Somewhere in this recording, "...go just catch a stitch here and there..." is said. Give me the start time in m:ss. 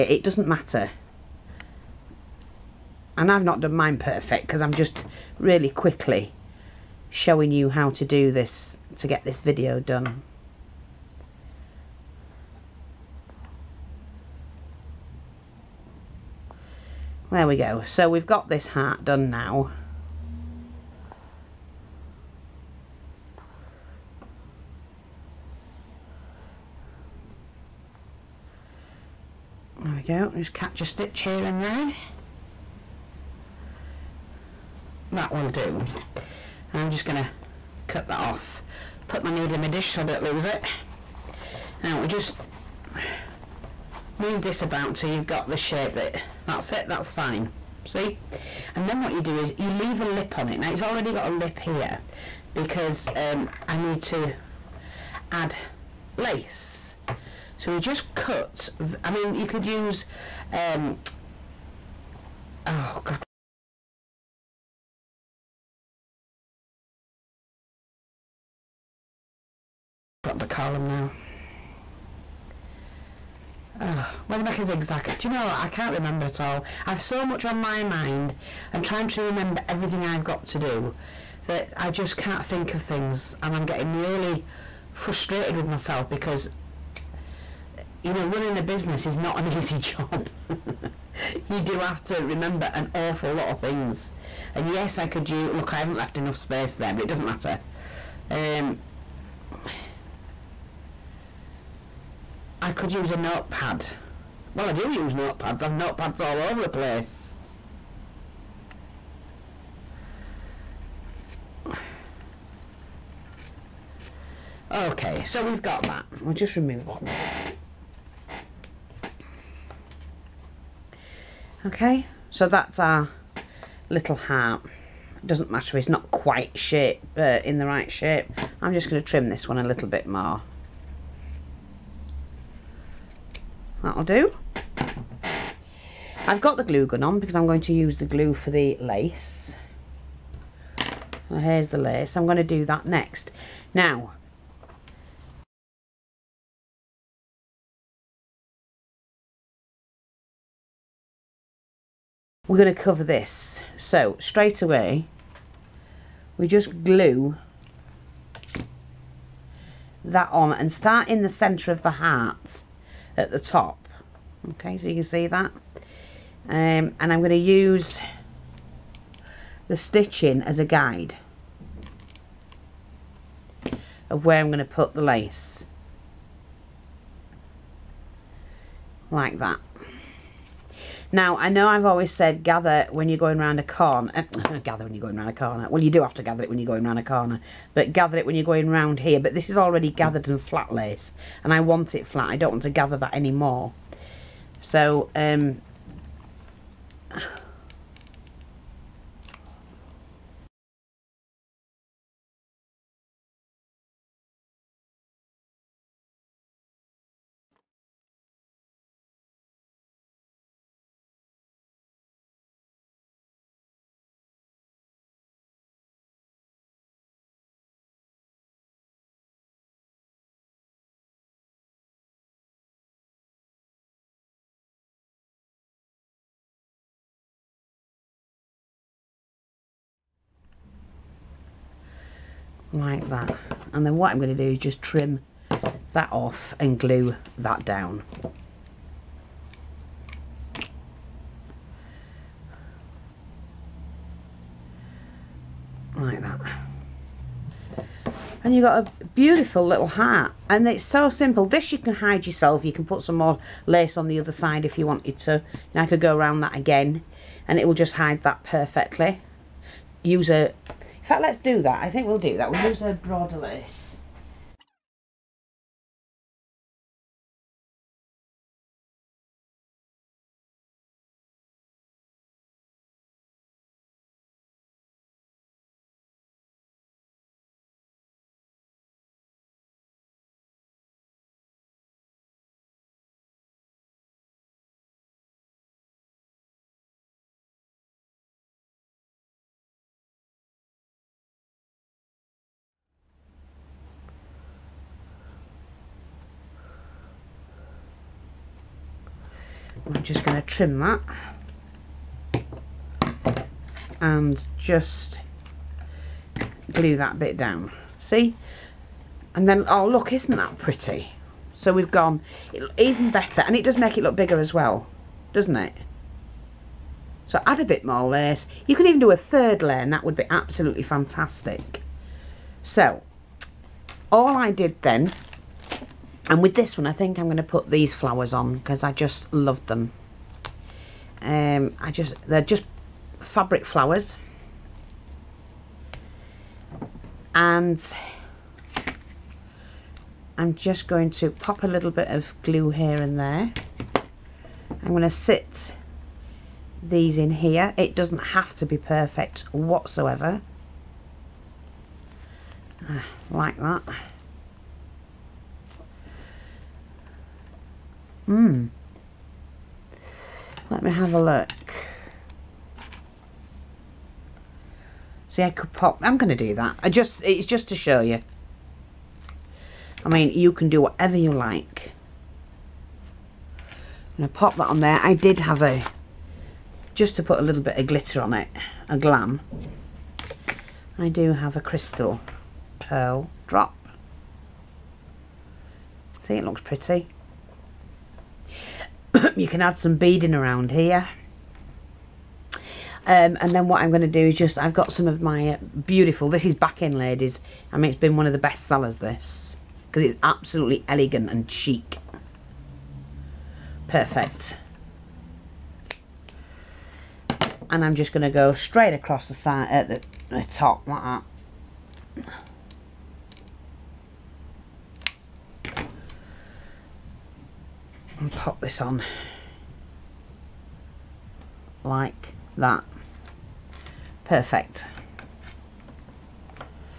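0:30.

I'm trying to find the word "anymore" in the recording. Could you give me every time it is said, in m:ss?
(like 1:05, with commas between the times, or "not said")
3:13.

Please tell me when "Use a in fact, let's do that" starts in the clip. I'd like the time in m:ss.
4:20.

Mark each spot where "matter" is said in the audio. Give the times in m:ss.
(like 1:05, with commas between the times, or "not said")
0:00, 1:37, 2:05.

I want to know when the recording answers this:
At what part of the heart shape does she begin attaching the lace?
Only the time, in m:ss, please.
2:41.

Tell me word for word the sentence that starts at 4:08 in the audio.
And you've got a beautiful little hat.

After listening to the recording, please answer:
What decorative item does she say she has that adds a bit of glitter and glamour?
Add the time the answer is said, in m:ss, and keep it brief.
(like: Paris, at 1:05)
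Crystal pearl drop, at 6:21.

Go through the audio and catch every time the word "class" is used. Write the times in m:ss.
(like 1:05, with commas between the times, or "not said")
not said.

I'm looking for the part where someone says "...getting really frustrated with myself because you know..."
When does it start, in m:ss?
1:23.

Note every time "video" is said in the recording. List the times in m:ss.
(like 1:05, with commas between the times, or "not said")
0:09.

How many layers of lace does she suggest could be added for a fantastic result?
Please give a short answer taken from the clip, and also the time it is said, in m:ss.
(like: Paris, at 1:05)
3, at 5:19.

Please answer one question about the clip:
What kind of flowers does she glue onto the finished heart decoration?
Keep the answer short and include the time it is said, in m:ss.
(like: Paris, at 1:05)
Fabric flowers, at 5:33.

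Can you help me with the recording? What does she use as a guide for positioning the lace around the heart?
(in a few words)
The stitching.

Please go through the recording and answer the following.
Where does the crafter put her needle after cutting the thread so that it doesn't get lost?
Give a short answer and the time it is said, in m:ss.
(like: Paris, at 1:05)
In my dish, at 0:39.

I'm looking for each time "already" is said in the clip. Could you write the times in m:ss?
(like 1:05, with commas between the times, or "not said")
0:50, 3:09.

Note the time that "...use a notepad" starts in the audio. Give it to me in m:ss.
1:42.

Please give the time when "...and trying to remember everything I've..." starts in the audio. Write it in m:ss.
1:18.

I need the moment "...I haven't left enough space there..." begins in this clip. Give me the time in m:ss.
1:35.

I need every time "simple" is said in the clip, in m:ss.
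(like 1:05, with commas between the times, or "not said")
4:11.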